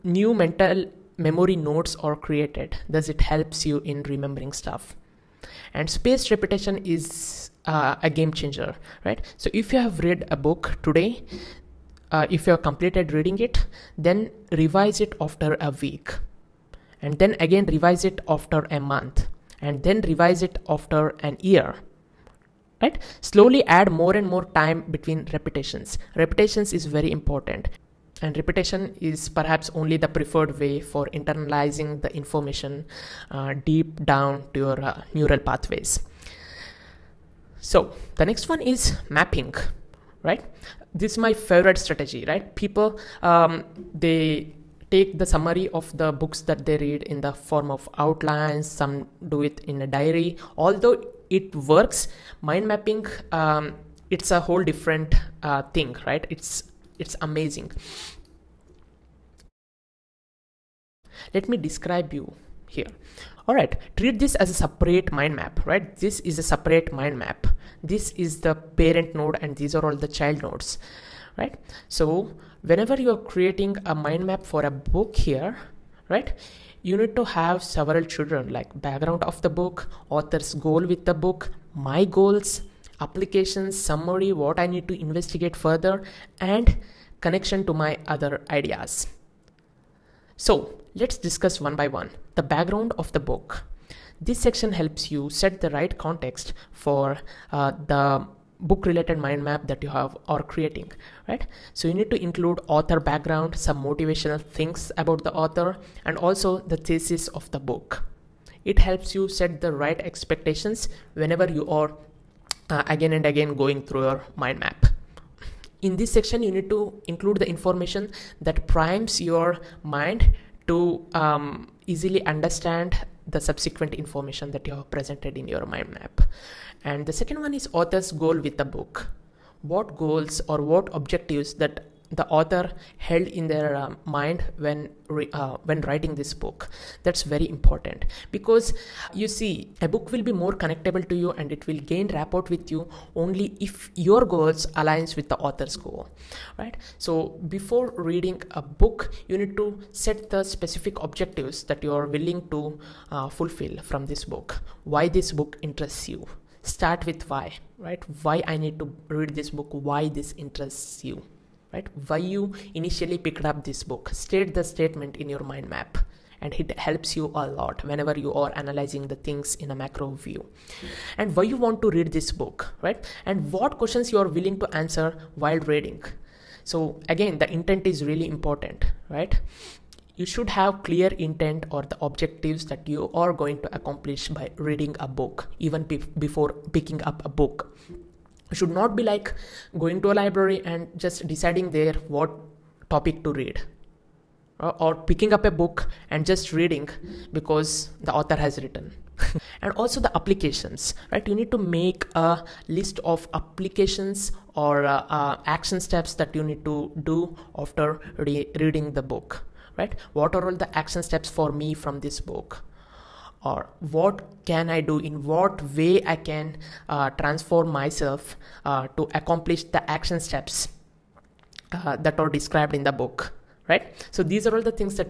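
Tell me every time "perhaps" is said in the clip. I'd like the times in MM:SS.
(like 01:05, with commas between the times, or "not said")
00:29.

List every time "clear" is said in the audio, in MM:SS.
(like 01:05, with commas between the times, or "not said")
03:00.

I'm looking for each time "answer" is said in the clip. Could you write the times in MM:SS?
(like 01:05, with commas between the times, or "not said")
02:54.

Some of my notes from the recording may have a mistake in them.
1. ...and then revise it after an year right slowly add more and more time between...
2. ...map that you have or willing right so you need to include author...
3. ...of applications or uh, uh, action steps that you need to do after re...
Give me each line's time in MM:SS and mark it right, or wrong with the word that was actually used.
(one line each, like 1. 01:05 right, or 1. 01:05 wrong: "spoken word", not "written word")
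1. 00:19 right
2. 01:39 wrong: "creating", not "willing"
3. 03:23 right.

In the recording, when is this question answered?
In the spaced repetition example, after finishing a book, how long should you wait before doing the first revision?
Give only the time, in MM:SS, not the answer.
00:15.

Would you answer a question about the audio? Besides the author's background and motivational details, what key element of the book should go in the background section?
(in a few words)
The thesis.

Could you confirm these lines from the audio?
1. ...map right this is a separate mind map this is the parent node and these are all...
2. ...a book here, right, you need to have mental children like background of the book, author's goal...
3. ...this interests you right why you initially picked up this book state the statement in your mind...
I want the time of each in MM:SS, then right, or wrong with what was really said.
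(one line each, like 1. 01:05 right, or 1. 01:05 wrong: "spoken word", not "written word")
1. 01:05 right
2. 01:14 wrong: "several", not "mental"
3. 02:40 right.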